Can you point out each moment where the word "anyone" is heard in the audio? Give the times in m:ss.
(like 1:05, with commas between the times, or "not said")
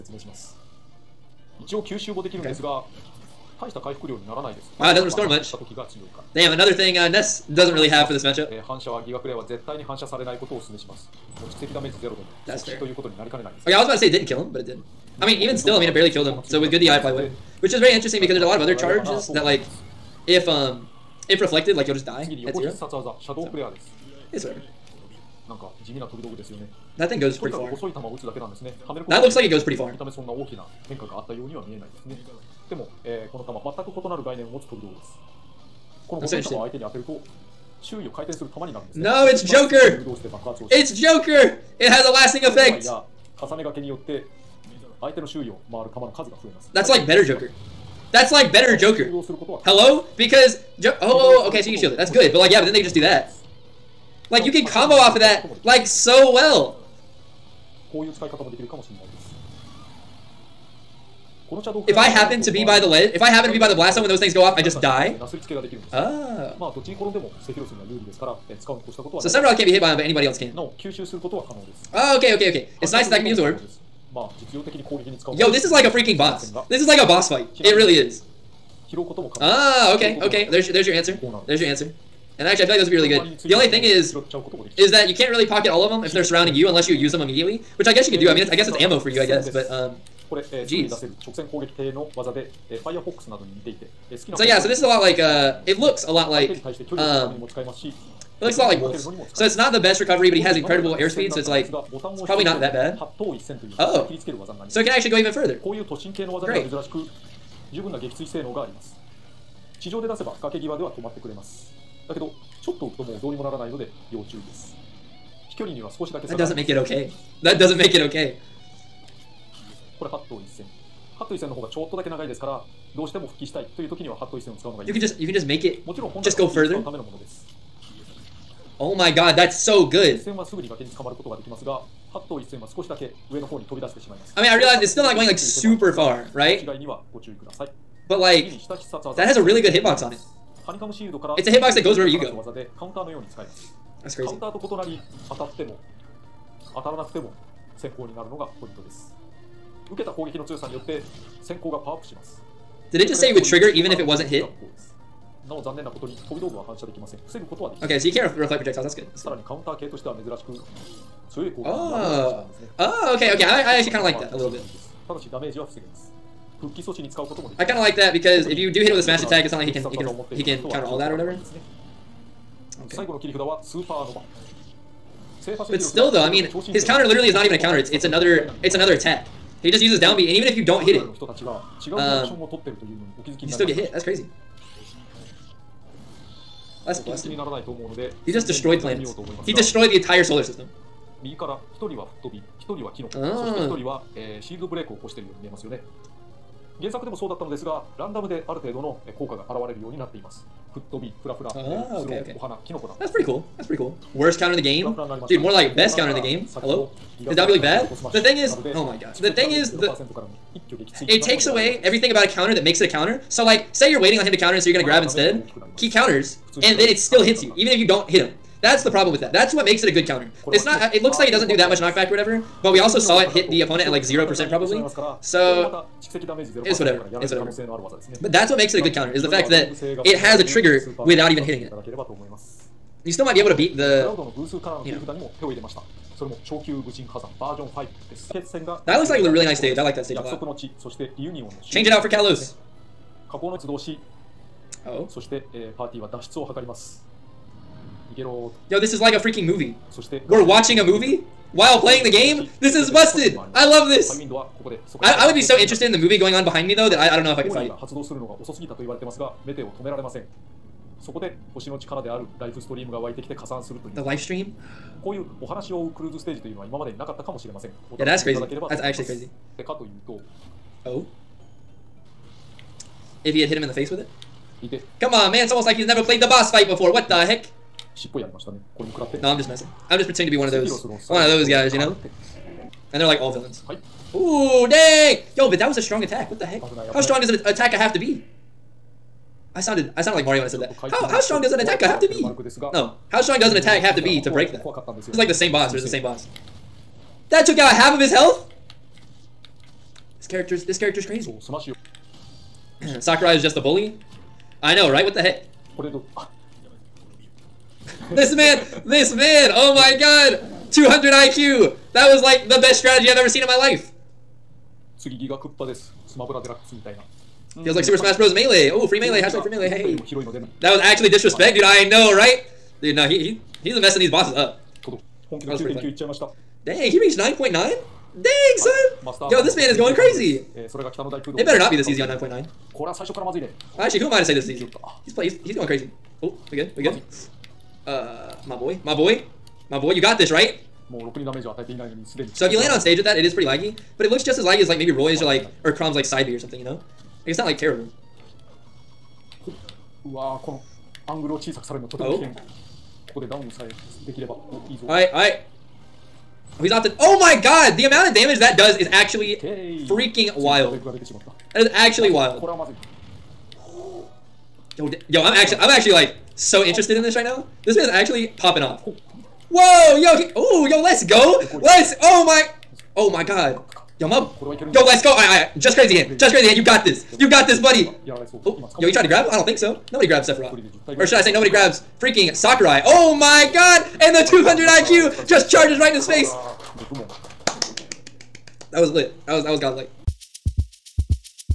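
not said.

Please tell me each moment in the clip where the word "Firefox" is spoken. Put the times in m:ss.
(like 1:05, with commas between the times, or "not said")
1:32.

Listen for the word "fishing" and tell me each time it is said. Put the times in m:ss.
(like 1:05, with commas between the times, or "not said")
not said.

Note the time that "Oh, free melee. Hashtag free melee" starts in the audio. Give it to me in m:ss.
5:18.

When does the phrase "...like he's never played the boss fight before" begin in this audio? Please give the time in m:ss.
4:35.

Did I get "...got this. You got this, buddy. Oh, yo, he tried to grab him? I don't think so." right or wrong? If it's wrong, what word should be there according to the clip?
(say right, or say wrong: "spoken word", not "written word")
right.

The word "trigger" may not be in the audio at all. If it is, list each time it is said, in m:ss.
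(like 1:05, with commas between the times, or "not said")
2:33, 3:50.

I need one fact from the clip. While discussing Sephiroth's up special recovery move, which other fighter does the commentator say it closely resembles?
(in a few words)
Wolf.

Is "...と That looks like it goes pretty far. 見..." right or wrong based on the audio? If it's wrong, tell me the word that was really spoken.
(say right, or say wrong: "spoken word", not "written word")
right.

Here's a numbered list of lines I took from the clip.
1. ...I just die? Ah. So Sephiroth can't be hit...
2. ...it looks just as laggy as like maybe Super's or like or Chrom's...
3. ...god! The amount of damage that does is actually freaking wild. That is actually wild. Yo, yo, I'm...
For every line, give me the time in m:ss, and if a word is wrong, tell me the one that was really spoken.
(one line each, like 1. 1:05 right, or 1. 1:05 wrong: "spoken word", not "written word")
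1. 1:04 right
2. 5:44 wrong: "Roy", not "Super"
3. 5:57 right.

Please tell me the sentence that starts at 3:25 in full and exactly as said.
Dude, more like best counter in the game.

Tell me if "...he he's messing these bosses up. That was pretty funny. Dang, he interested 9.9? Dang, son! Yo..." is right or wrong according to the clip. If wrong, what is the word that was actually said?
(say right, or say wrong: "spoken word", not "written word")
wrong: "reached", not "interested".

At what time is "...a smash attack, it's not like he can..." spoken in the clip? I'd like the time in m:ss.
2:48.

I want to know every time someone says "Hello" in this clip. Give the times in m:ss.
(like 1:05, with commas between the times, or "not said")
0:49, 3:26.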